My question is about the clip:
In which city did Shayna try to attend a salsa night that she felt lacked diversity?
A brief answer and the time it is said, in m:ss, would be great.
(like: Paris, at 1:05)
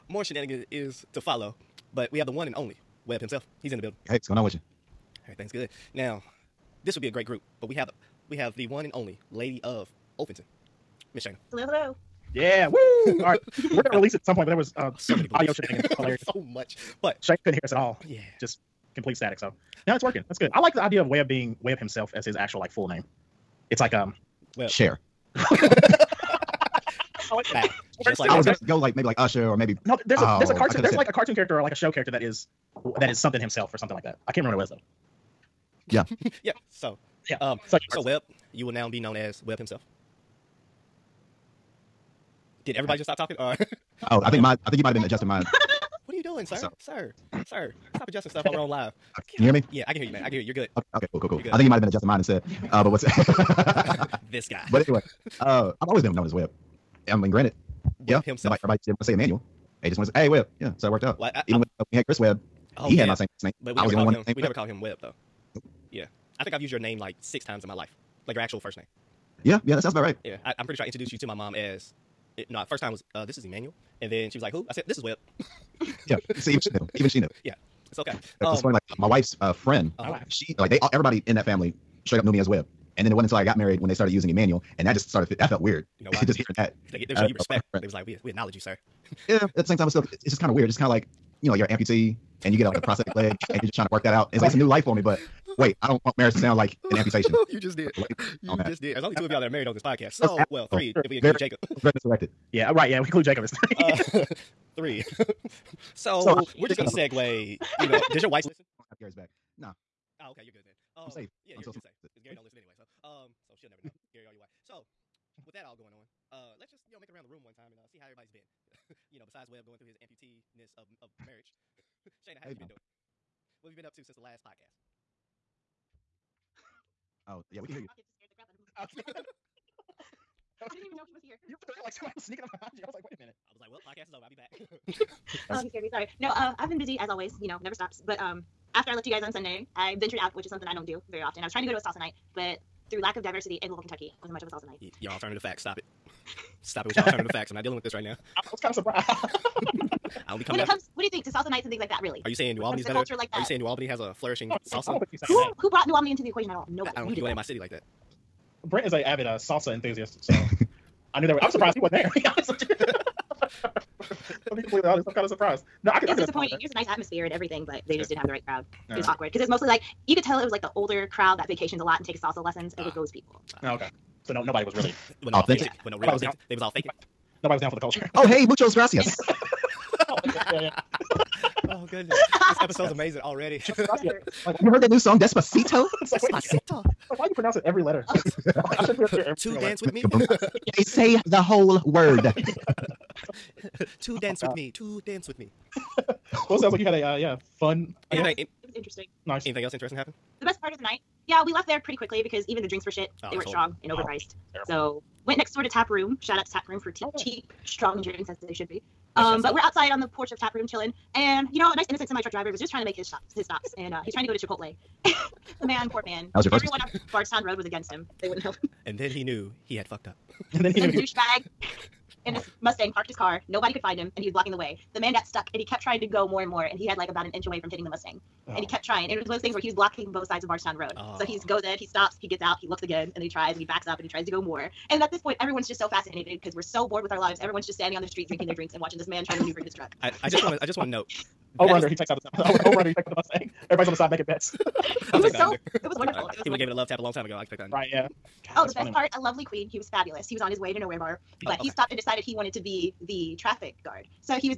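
Louisville, Kentucky, at 2:23.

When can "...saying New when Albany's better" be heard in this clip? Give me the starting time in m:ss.
2:32.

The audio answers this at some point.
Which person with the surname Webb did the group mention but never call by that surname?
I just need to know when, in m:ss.
1:02.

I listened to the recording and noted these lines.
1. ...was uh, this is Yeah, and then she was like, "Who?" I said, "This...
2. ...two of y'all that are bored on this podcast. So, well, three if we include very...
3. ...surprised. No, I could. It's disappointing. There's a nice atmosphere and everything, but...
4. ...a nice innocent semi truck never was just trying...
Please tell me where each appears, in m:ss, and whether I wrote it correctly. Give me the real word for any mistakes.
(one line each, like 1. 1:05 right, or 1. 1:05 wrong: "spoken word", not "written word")
1. 1:12 wrong: "Emmanuel", not "Yeah"
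2. 1:39 wrong: "married", not "bored"
3. 2:45 right
4. 3:31 wrong: "driver", not "never".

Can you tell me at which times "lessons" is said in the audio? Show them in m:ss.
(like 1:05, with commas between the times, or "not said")
2:52.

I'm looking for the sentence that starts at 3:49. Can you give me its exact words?
And it was one of those things where he was blocking both sides of Bardstown Road.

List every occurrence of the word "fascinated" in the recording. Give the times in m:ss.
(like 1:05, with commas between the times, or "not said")
3:55.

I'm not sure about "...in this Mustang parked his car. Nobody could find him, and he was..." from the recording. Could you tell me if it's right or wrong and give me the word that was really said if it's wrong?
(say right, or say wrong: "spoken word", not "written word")
right.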